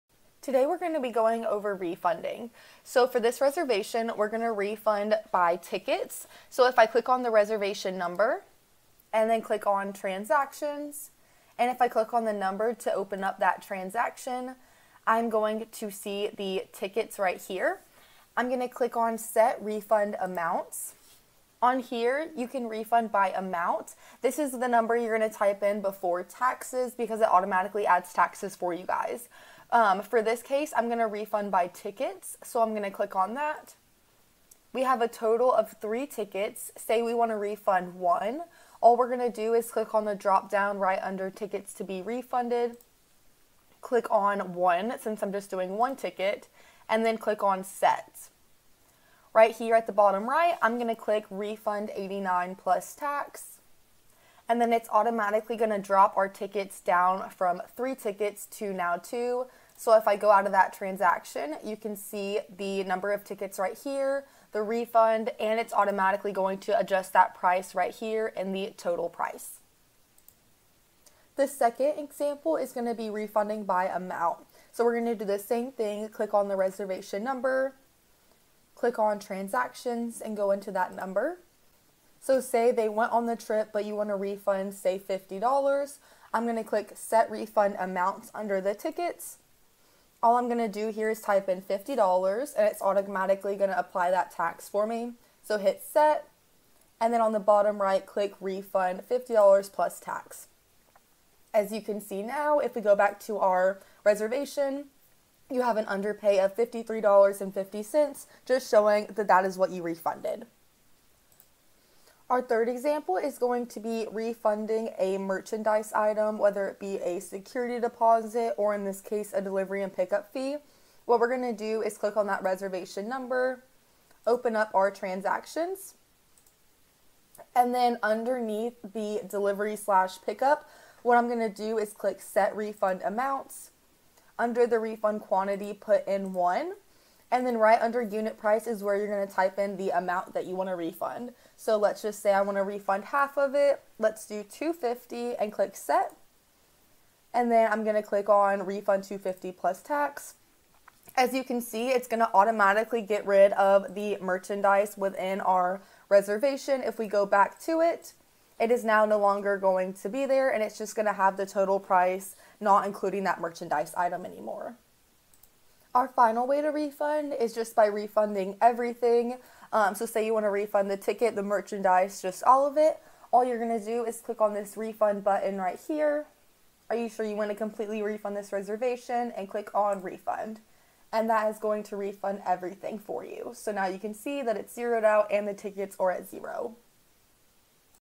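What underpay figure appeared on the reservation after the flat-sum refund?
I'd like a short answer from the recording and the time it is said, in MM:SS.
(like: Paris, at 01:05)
$53.50, at 01:46.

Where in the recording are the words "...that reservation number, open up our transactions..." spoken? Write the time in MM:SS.
02:02.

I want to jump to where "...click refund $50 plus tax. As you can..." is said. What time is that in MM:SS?
01:38.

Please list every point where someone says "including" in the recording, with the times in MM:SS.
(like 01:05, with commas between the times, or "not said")
02:42.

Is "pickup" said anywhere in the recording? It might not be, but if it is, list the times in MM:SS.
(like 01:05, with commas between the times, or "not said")
01:59, 02:10.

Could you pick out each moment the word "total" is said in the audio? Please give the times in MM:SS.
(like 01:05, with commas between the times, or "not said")
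00:35, 01:08, 02:41.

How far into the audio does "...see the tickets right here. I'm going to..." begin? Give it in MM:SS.
00:15.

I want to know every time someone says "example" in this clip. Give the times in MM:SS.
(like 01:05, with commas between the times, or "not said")
01:11, 01:52.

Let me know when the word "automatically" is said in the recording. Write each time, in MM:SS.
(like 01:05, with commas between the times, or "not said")
00:27, 00:54, 01:05, 01:32, 02:32.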